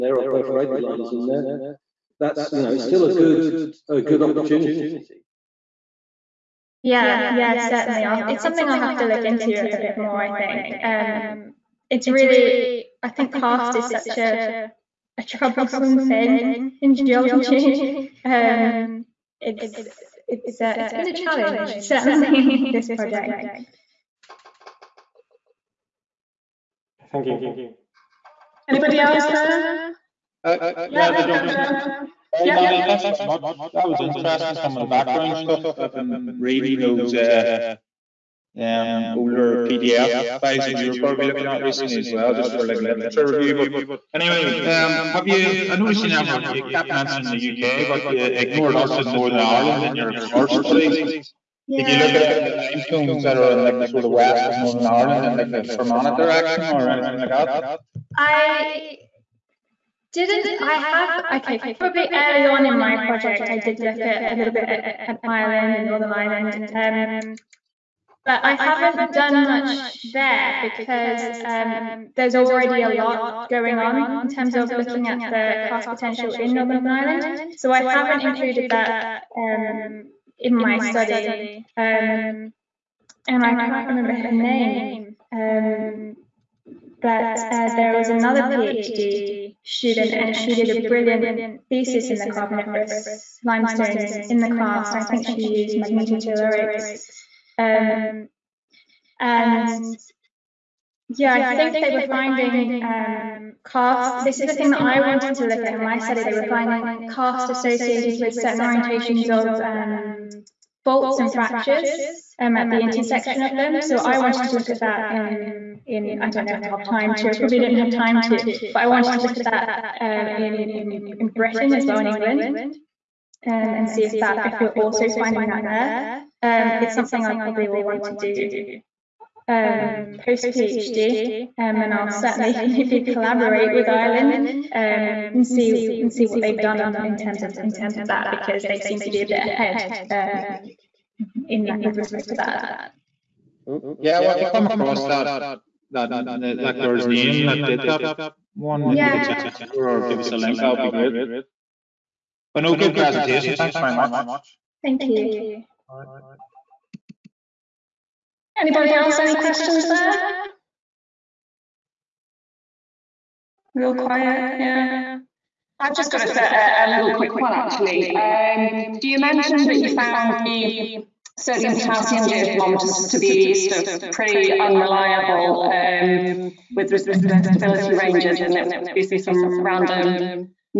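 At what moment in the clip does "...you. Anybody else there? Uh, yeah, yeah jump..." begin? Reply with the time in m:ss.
0:27.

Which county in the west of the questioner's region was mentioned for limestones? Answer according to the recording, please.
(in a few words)
Fermanagh.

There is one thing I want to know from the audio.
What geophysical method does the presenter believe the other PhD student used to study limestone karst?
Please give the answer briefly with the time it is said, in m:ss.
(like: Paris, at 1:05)
Magnetotellurics, at 1:35.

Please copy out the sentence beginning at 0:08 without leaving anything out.
I'll, it's something I'll have to look into a bit more.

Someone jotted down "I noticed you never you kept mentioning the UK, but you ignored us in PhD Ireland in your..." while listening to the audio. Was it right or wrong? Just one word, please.
wrong.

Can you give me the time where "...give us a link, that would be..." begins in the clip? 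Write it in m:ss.
2:30.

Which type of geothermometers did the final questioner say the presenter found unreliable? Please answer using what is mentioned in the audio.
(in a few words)
Sodium potassium.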